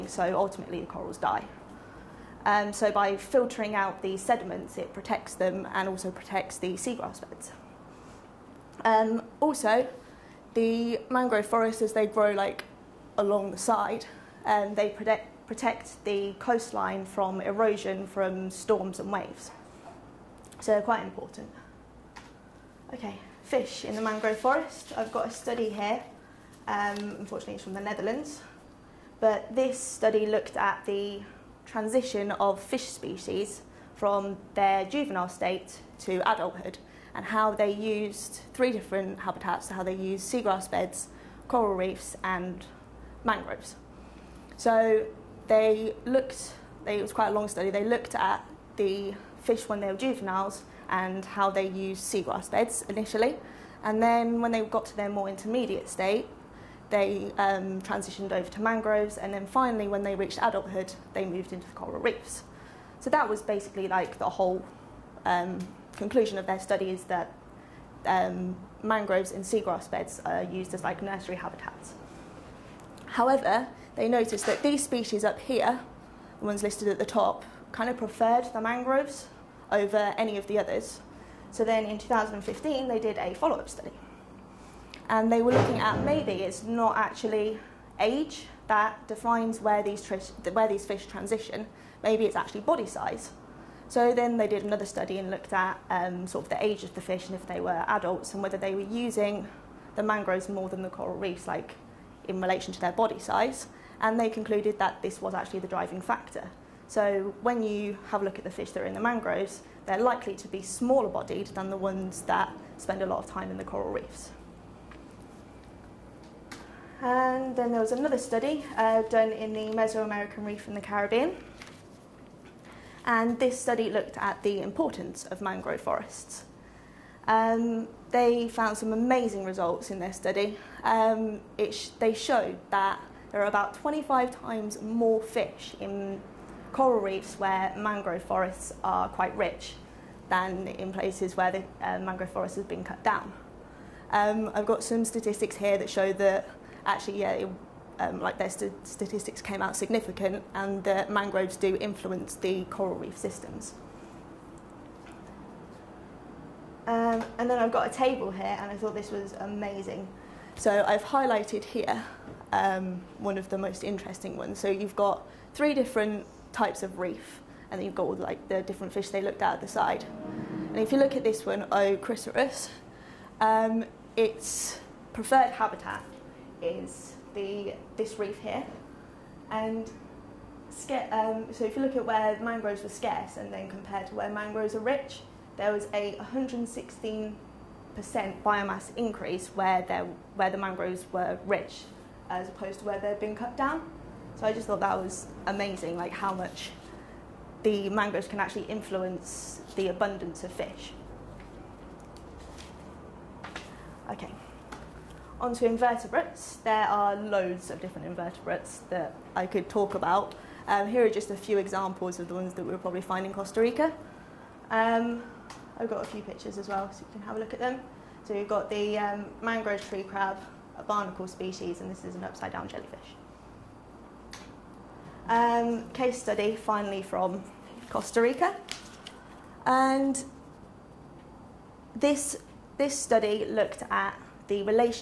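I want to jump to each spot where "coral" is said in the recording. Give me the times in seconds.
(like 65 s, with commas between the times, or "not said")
0 s, 41 s, 61 s, 100 s, 113 s, 136 s, 152 s.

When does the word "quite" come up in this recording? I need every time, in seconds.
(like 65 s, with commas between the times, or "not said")
20 s, 47 s, 139 s.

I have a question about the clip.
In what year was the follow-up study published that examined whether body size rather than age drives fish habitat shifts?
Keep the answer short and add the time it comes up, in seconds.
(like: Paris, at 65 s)
2015, at 81 s.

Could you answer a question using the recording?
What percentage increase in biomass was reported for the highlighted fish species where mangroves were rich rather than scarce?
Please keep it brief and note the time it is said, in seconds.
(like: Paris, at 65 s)
116%, at 186 s.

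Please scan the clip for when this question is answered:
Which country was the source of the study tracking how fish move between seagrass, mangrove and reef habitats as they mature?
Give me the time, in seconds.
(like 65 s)
27 s.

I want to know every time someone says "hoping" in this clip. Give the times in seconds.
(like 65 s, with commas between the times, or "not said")
not said.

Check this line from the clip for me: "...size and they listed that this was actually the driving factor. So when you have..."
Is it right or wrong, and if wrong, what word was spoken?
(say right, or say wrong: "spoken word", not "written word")
wrong: "concluded", not "listed".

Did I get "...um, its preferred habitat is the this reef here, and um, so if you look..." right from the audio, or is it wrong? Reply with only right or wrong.
right.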